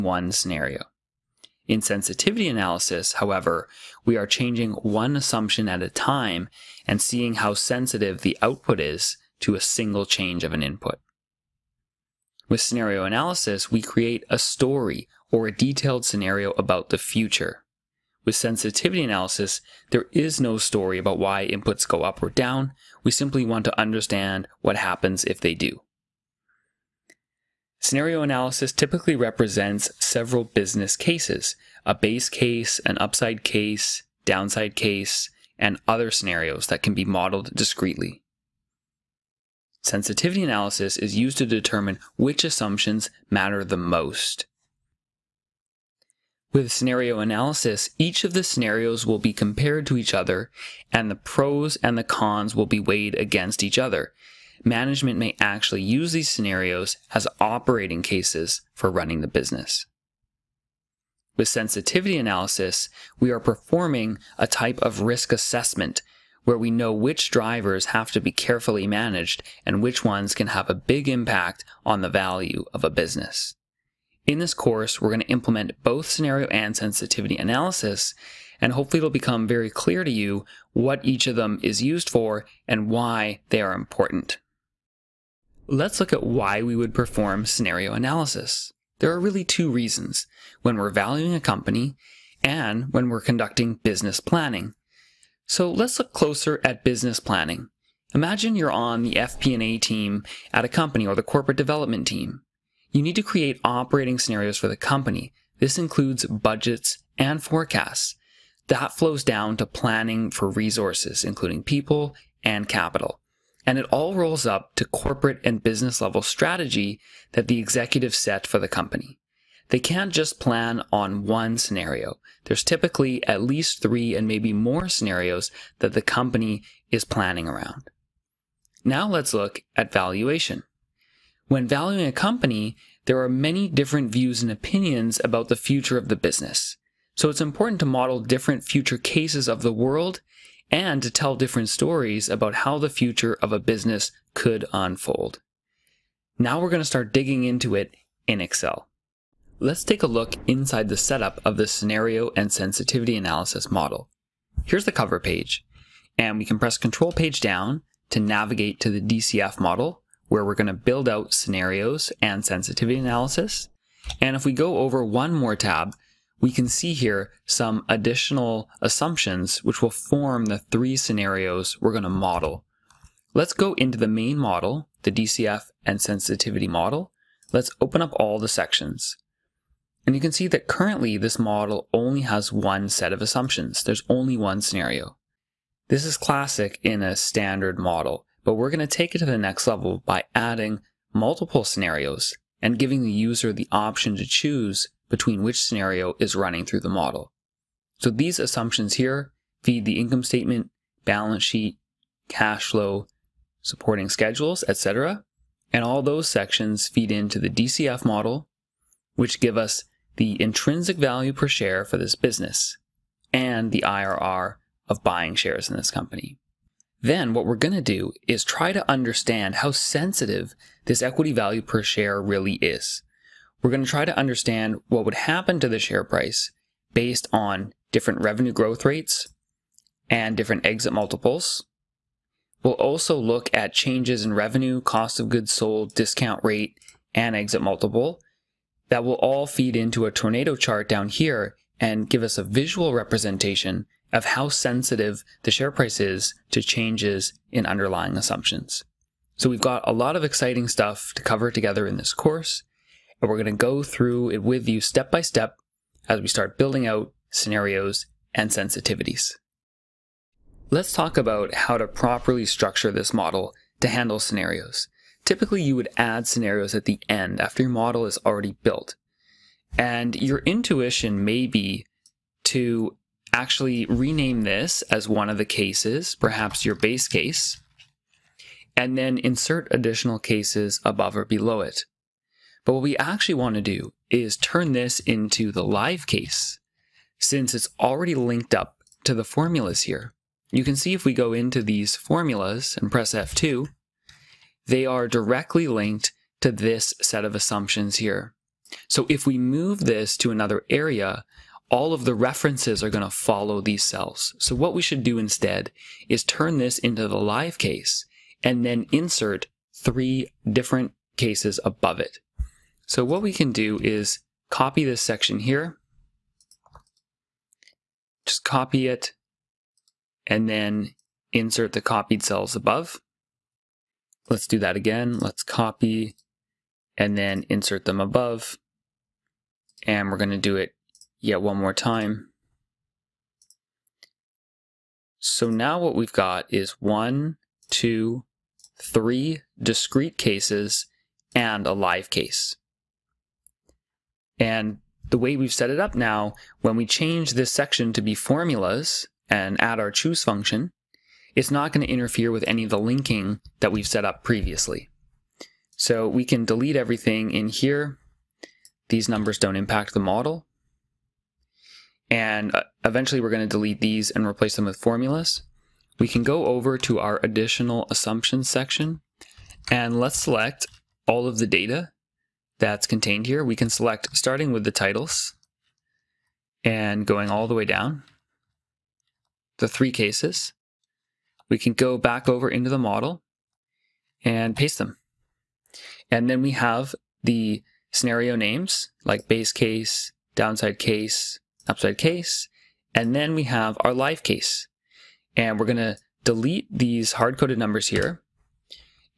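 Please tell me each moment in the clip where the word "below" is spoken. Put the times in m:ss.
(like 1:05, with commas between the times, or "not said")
4:41.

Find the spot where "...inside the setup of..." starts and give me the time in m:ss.
2:30.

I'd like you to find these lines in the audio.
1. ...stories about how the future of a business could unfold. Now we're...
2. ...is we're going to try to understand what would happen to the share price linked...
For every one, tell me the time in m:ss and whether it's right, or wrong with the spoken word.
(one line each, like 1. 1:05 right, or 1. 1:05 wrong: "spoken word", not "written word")
1. 2:21 right
2. 3:42 wrong: "based", not "linked".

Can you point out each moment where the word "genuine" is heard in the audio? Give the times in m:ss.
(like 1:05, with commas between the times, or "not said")
not said.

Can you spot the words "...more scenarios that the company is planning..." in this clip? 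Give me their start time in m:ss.
2:04.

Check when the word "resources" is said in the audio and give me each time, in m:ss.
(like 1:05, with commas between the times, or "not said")
1:50.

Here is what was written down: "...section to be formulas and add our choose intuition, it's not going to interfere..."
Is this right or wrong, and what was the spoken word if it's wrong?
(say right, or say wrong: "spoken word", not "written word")
wrong: "function", not "intuition".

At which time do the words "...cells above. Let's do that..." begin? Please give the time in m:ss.
5:22.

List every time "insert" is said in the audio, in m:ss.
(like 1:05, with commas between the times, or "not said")
4:39, 5:08, 5:21, 5:27.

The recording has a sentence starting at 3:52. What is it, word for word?
We'll also look at changes in revenue, cost of goods sold, discount rate, and exit multiple.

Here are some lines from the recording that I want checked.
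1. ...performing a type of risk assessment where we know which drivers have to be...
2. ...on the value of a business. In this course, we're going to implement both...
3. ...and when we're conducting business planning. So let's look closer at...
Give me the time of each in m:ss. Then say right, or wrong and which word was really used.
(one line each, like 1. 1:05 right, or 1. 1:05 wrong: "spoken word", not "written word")
1. 1:03 right
2. 1:11 right
3. 1:32 right.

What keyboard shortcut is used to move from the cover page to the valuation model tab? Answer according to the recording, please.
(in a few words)
Control page down.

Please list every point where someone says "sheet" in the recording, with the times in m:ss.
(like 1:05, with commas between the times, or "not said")
3:21.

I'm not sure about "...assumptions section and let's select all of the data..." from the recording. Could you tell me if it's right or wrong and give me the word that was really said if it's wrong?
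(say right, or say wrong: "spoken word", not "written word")
right.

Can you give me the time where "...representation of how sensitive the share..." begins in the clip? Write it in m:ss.
4:02.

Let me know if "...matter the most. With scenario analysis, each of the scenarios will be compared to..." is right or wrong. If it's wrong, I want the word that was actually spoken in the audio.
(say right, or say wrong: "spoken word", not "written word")
right.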